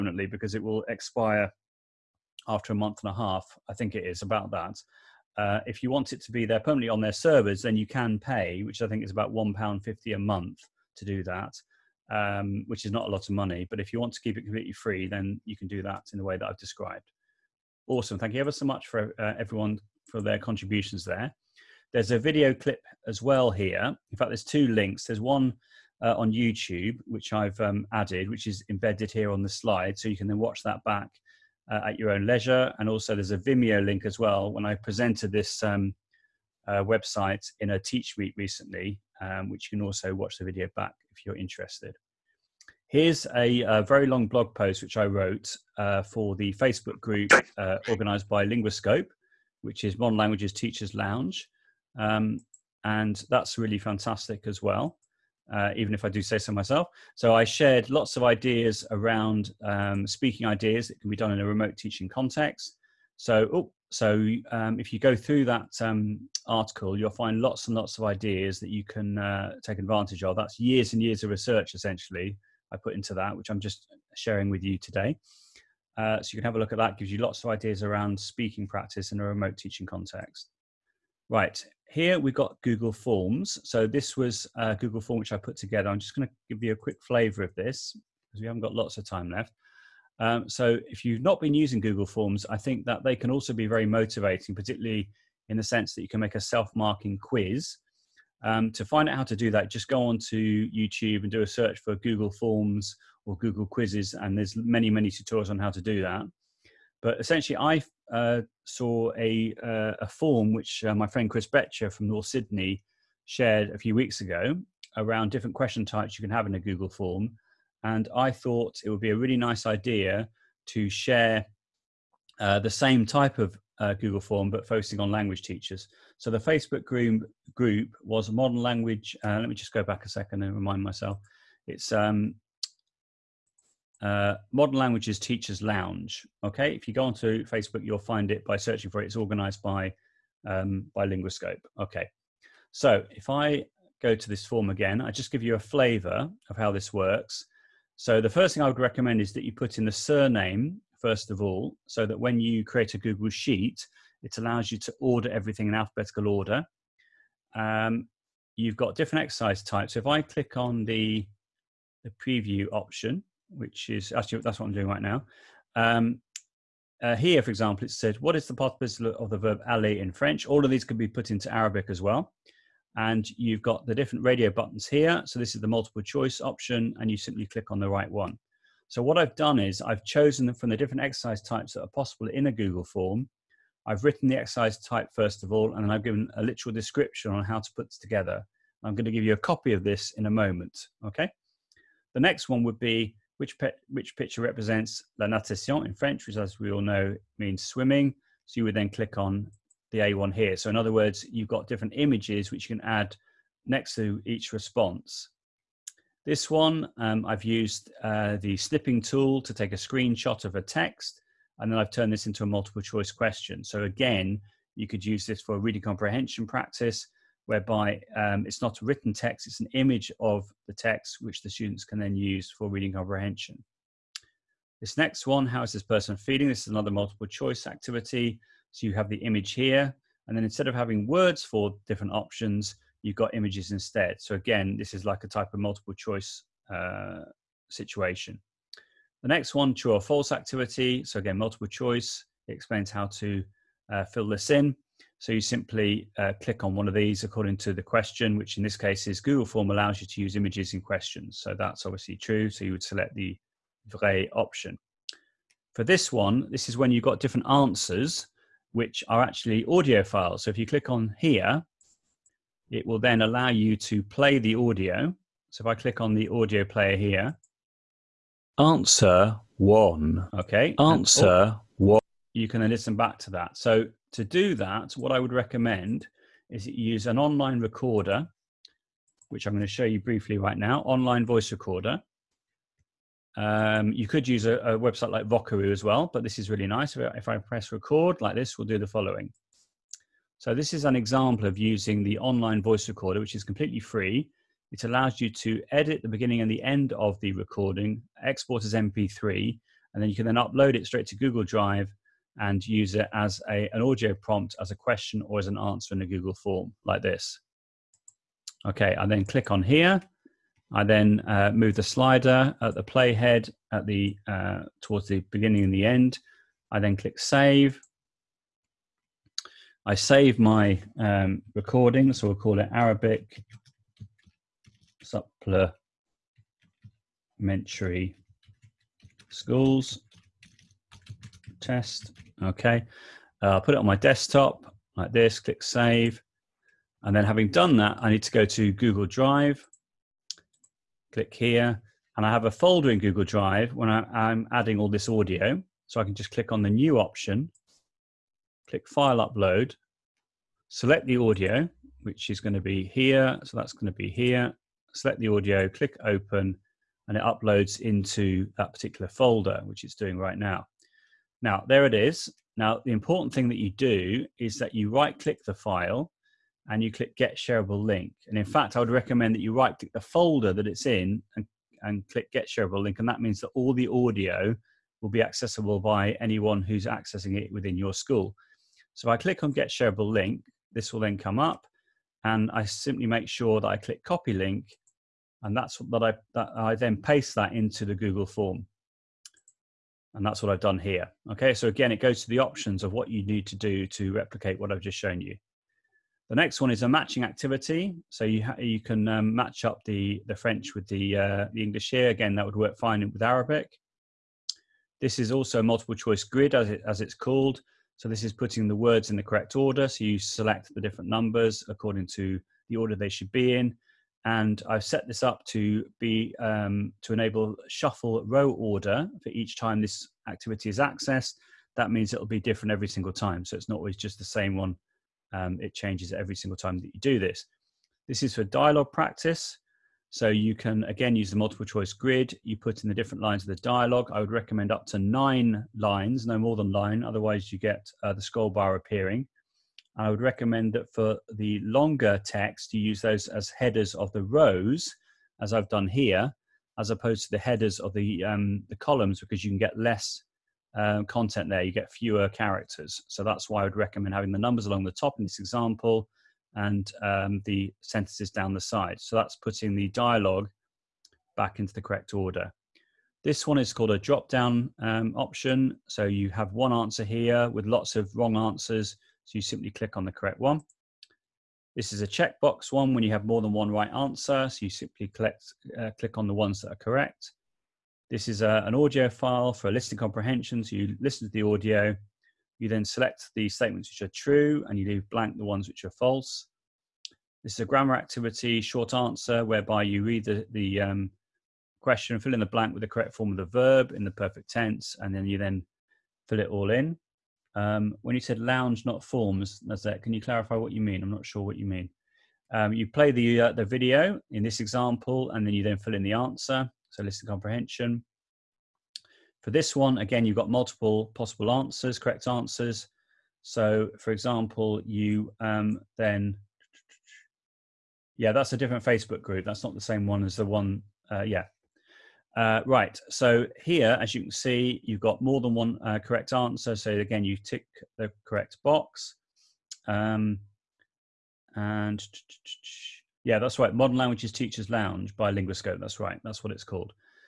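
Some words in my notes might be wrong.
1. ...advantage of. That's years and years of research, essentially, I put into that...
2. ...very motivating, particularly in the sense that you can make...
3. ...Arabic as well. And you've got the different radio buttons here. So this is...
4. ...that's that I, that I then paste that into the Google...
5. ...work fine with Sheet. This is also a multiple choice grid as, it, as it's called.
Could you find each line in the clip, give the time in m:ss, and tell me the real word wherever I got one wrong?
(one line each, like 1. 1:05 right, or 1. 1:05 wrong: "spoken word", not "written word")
1. 1:09 right
2. 1:33 right
3. 2:51 right
4. 6:25 right
5. 6:42 wrong: "Arabic", not "Sheet".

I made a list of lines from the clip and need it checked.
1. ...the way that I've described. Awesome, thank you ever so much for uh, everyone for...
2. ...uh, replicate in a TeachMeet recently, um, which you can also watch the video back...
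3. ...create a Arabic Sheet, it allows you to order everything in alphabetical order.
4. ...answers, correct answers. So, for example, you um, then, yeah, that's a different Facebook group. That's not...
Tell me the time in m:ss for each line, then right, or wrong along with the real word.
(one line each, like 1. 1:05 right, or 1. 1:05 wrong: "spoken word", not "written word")
1. 0:16 right
2. 0:36 wrong: "website", not "replicate"
3. 2:32 wrong: "Google", not "Arabic"
4. 8:31 right.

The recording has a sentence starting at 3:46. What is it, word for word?
This is another multiple choice activity.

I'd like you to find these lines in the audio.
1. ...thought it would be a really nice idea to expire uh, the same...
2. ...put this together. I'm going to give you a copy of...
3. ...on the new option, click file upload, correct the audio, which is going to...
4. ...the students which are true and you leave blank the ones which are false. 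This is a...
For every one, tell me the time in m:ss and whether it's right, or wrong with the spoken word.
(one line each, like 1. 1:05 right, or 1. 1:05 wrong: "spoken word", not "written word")
1. 1:58 wrong: "share", not "expire"
2. 3:07 right
3. 5:46 wrong: "select", not "correct"
4. 8:03 wrong: "statements", not "students".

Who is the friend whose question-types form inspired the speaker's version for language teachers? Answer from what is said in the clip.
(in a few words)
Chris Betcher.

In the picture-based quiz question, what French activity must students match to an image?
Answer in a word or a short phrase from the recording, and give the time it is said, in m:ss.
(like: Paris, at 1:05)
la natation, at 3:15.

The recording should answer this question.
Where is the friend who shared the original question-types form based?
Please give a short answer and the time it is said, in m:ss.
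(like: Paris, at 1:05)
North Sydney, at 1:52.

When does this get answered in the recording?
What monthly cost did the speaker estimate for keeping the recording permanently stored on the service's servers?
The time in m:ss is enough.
0:09.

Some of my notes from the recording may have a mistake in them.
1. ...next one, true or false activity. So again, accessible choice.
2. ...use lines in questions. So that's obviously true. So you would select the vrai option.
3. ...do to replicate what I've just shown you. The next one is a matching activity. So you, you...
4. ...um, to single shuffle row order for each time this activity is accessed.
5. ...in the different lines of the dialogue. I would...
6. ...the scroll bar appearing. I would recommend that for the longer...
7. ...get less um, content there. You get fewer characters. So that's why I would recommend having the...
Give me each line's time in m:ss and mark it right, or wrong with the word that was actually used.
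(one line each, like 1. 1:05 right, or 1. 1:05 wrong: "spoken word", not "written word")
1. 3:59 wrong: "multiple", not "accessible"
2. 4:10 wrong: "images", not "lines"
3. 6:33 right
4. 6:56 wrong: "enable", not "single"
5. 7:12 right
6. 7:18 right
7. 7:29 right.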